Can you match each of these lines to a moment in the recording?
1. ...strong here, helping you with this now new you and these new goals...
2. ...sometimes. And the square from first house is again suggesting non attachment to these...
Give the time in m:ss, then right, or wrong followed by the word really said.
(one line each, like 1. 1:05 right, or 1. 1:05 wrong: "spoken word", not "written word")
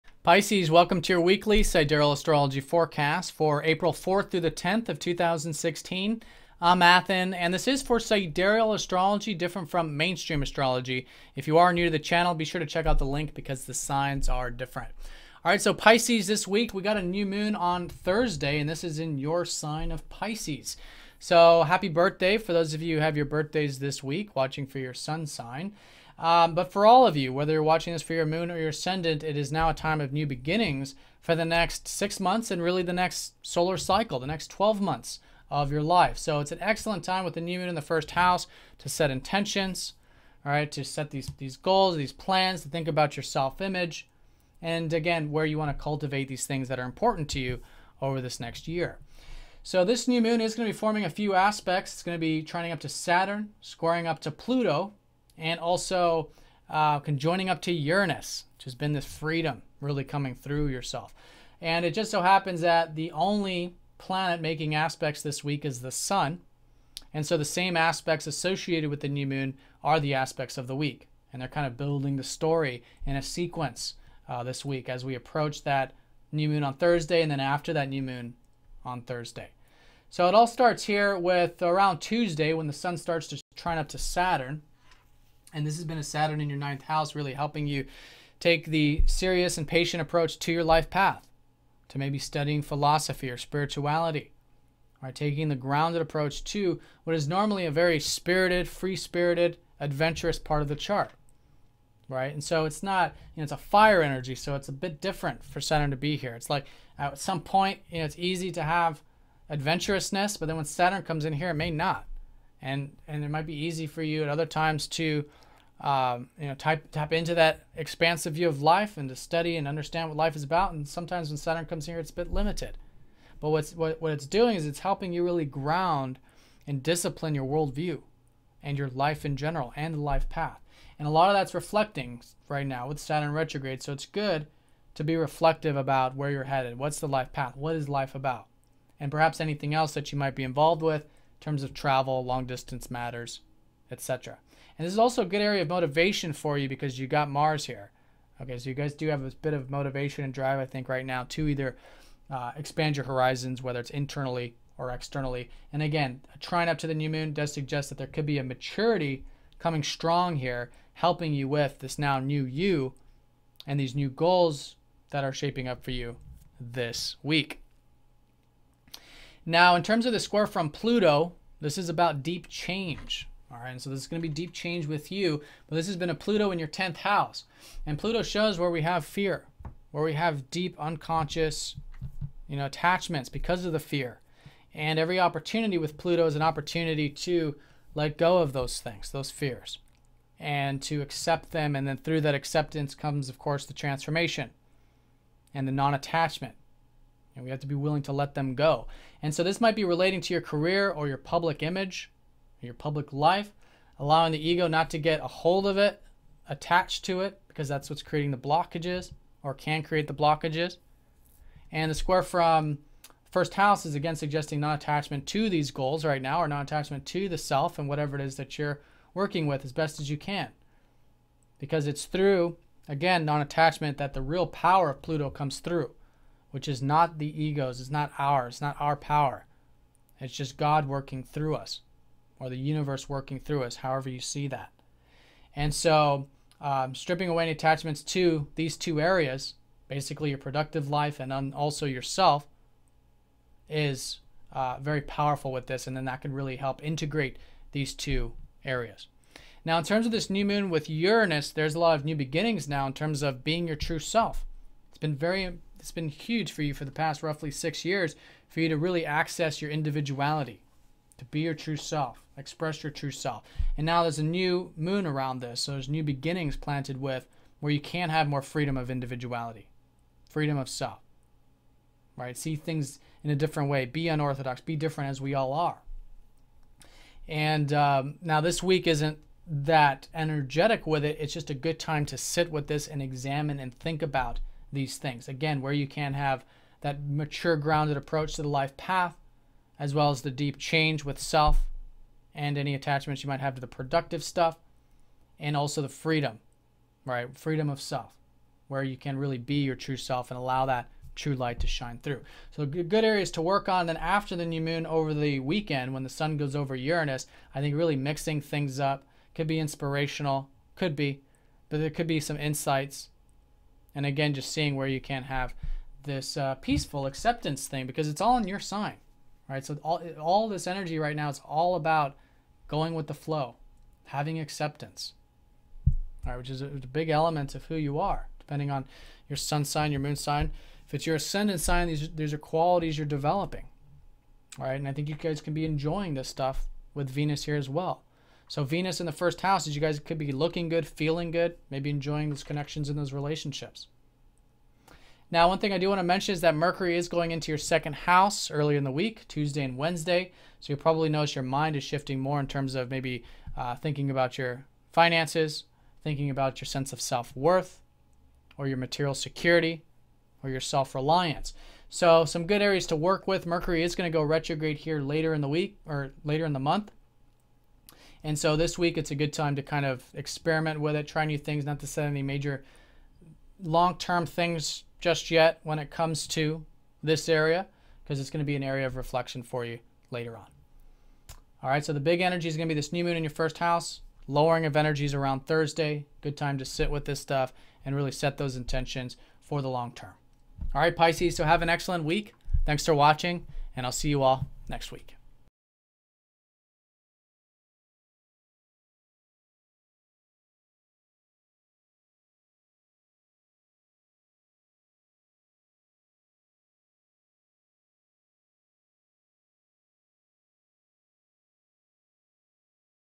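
1. 2:39 right
2. 3:30 wrong: "blockages", not "sometimes".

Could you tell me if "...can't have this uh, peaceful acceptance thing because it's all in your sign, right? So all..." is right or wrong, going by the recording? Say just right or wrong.
right.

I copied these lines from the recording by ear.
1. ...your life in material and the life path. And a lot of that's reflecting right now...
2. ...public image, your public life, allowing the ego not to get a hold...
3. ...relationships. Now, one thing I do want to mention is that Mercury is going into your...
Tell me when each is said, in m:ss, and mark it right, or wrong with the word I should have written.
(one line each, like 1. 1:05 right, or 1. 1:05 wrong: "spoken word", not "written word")
1. 2:08 wrong: "general", not "material"
2. 3:21 right
3. 5:43 right.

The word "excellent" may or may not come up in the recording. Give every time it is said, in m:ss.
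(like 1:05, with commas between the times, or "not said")
0:36, 6:31.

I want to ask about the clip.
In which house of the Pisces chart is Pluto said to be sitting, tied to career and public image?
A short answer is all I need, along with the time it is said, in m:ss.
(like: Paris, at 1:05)
10th house, at 2:56.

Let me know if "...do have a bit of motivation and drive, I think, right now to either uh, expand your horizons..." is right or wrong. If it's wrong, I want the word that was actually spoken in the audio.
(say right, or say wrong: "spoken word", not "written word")
right.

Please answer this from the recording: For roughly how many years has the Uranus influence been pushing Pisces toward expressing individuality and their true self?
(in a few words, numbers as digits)
6 years.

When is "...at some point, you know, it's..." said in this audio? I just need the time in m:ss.
1:46.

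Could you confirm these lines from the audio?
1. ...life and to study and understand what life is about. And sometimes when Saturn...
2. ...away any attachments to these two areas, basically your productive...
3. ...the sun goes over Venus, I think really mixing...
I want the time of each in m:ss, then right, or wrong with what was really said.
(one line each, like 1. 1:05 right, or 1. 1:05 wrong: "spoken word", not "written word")
1. 1:58 right
2. 3:57 right
3. 5:06 wrong: "Uranus", not "Venus".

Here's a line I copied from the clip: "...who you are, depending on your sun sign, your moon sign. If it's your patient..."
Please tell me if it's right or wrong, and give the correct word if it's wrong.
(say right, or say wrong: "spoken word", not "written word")
wrong: "ascendant", not "patient".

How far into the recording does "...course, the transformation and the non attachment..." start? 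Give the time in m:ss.
3:13.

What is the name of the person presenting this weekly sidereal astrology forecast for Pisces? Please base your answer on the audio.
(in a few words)
Athen.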